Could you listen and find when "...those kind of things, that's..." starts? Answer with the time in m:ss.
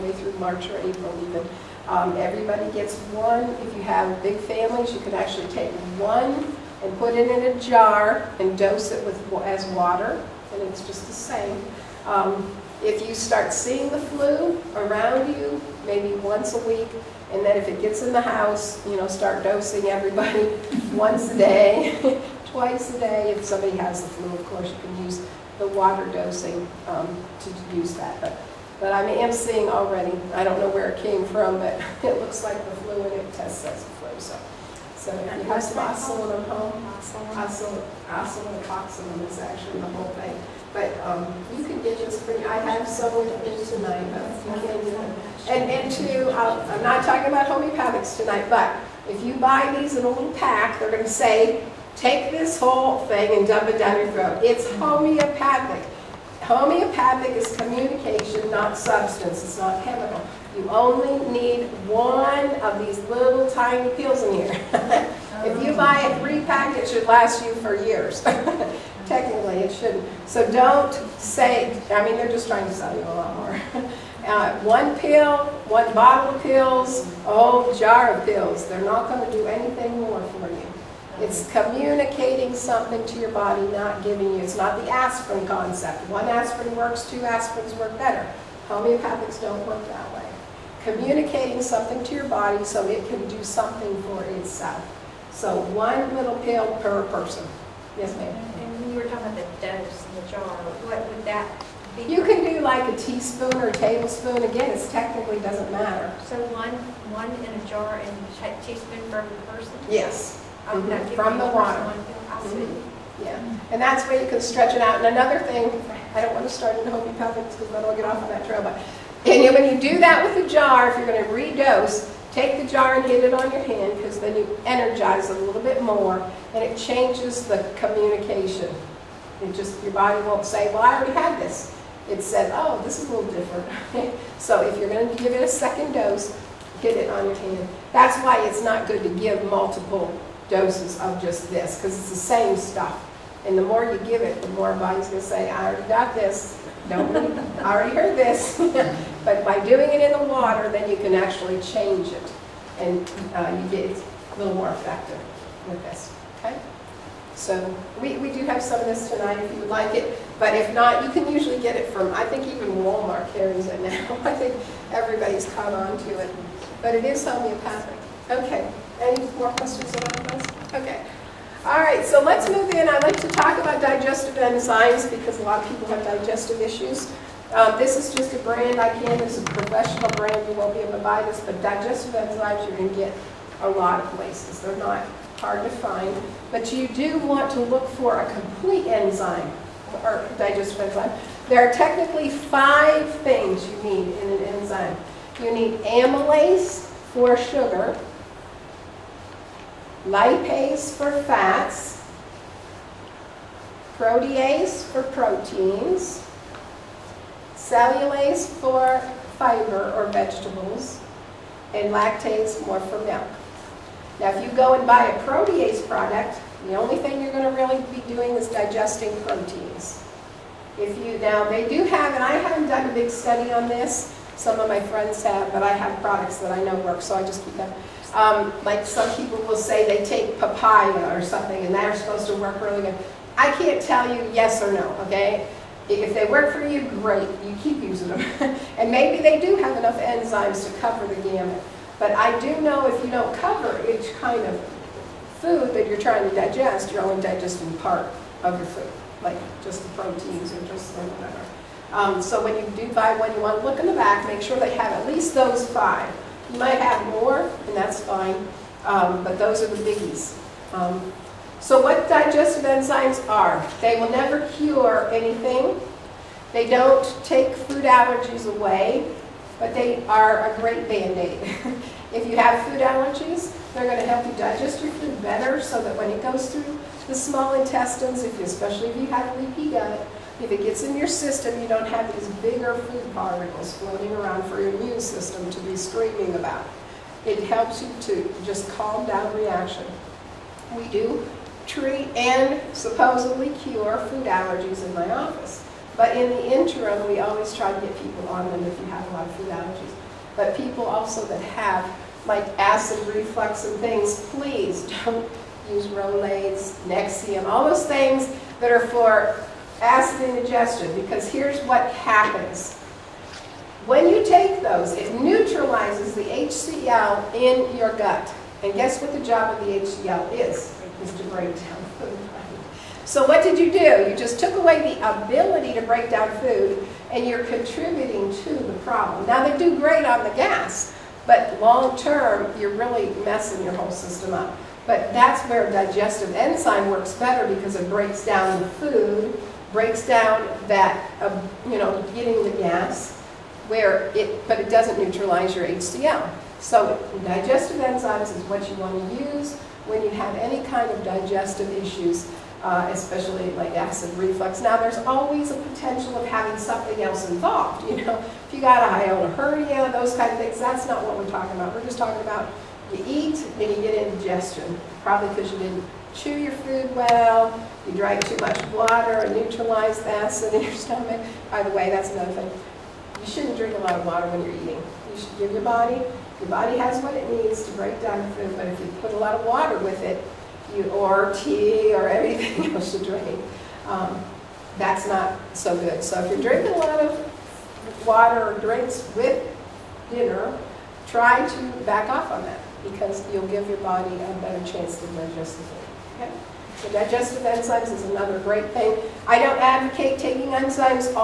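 5:59.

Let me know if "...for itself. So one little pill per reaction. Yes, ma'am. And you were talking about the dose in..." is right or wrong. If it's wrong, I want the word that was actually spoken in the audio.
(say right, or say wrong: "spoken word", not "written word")
wrong: "person", not "reaction".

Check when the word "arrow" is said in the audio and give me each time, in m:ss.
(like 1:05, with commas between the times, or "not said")
not said.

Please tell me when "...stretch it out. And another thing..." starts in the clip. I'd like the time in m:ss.
1:54.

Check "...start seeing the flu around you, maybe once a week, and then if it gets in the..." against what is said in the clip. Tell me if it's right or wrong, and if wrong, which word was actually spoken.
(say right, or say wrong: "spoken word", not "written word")
right.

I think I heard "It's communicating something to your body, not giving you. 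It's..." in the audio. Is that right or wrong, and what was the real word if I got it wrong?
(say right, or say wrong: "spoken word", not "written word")
right.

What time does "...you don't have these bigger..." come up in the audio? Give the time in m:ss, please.
4:41.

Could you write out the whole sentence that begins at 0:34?
So, so if you have some ocelin at home, ocelin is actually the whole thing.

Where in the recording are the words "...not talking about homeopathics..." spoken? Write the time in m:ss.
0:46.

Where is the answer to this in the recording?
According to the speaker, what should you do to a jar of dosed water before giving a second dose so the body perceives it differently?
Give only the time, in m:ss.
2:03.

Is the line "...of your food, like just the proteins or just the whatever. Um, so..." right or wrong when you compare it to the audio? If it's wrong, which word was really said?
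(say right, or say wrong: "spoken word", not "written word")
right.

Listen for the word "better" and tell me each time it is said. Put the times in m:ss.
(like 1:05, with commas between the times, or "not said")
1:27, 4:35, 5:37, 6:34.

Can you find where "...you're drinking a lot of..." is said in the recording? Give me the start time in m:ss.
6:26.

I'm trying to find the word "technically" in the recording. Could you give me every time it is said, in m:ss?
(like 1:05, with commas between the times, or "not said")
1:09, 1:44, 3:11.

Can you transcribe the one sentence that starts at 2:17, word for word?
That's why it's not good to give multiple doses of just this because it's the same stuff.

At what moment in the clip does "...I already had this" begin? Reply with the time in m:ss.
2:10.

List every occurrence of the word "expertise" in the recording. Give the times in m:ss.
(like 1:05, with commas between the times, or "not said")
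not said.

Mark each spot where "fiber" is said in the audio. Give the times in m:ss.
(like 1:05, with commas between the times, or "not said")
3:29.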